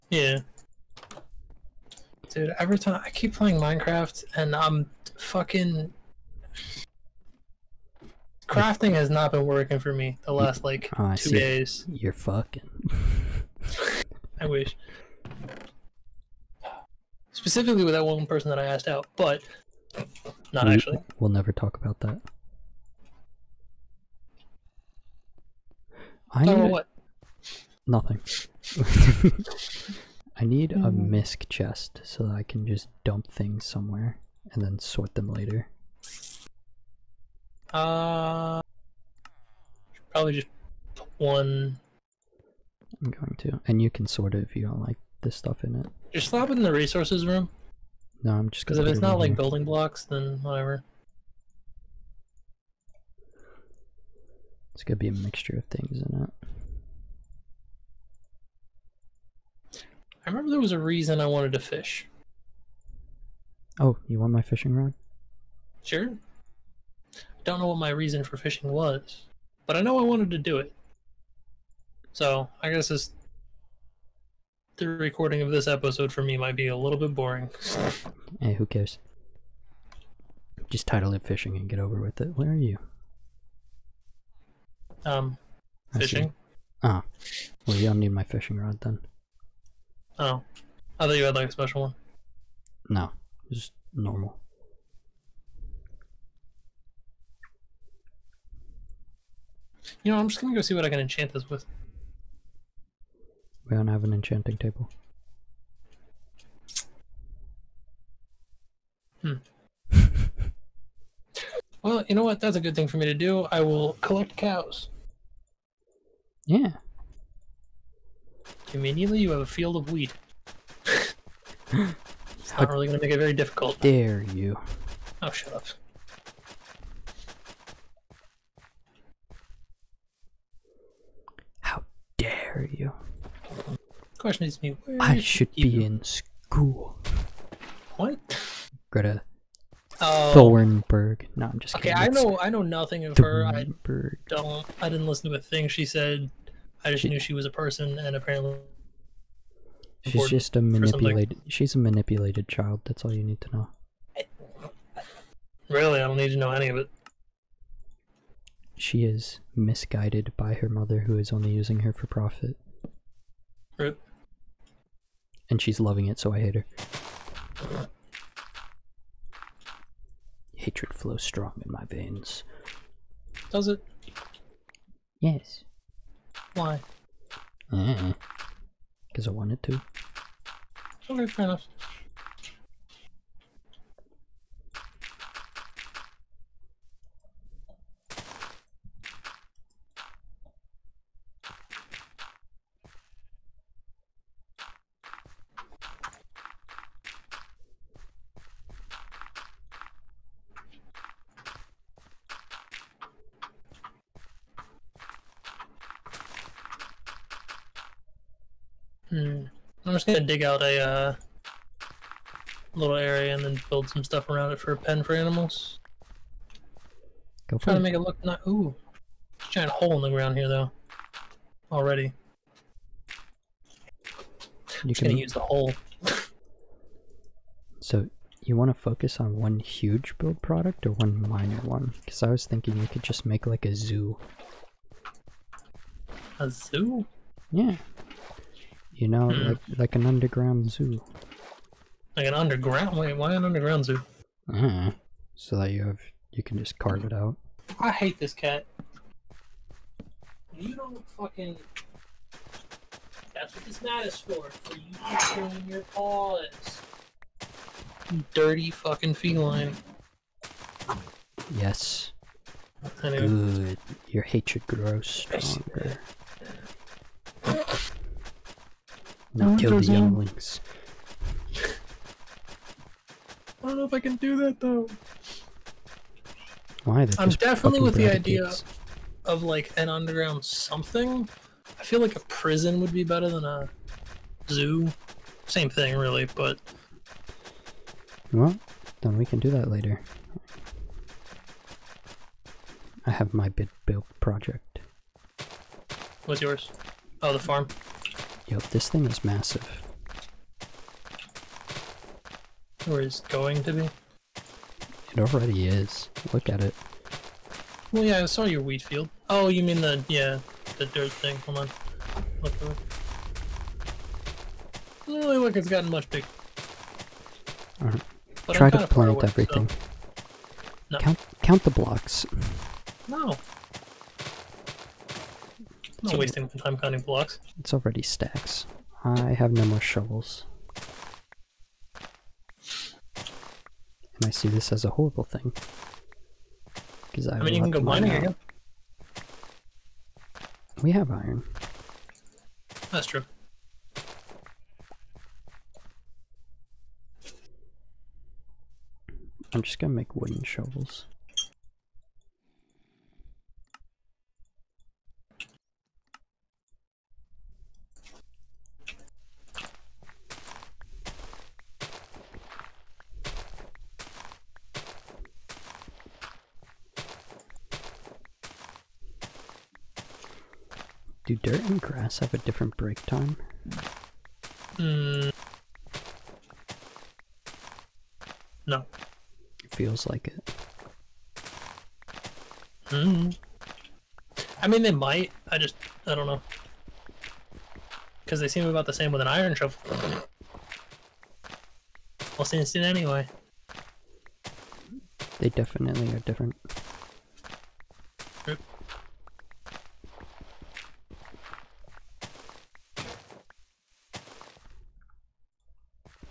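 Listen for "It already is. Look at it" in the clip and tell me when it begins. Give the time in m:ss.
5:05.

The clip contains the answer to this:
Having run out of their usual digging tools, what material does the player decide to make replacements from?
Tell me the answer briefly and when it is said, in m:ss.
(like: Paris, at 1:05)
wooden, at 5:50.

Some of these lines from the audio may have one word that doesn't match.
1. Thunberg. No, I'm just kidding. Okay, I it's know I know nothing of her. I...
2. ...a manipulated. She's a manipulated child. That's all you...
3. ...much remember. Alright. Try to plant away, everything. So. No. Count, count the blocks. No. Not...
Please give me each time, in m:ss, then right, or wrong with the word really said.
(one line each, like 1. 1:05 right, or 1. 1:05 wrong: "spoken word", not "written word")
1. 2:20 right
2. 2:30 right
3. 5:15 wrong: "bigger", not "remember".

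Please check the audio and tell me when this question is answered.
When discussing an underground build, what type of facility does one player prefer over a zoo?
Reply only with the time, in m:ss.
4:42.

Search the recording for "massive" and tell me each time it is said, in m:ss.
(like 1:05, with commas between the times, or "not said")
4:59.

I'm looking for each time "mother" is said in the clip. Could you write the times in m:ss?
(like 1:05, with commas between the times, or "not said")
2:40.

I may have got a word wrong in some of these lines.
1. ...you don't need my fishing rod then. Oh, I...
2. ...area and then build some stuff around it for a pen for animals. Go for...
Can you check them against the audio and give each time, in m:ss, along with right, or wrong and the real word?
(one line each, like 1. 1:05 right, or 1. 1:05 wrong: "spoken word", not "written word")
1. 1:27 right
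2. 3:32 right.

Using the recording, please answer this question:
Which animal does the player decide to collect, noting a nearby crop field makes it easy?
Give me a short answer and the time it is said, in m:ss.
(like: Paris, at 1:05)
cows, at 1:54.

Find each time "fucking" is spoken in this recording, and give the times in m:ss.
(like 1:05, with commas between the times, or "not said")
0:05, 0:12, 4:11, 4:18.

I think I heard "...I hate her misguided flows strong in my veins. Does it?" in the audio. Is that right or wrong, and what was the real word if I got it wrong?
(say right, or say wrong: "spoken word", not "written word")
wrong: "hatred", not "misguided".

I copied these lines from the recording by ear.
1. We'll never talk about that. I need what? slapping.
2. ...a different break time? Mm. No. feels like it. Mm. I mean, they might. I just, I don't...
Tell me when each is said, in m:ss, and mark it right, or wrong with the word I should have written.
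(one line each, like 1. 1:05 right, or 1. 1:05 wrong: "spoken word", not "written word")
1. 0:21 wrong: "nothing", not "slapping"
2. 6:12 right.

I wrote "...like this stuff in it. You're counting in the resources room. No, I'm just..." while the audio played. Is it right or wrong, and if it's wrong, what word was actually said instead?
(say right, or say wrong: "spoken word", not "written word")
wrong: "slapping", not "counting".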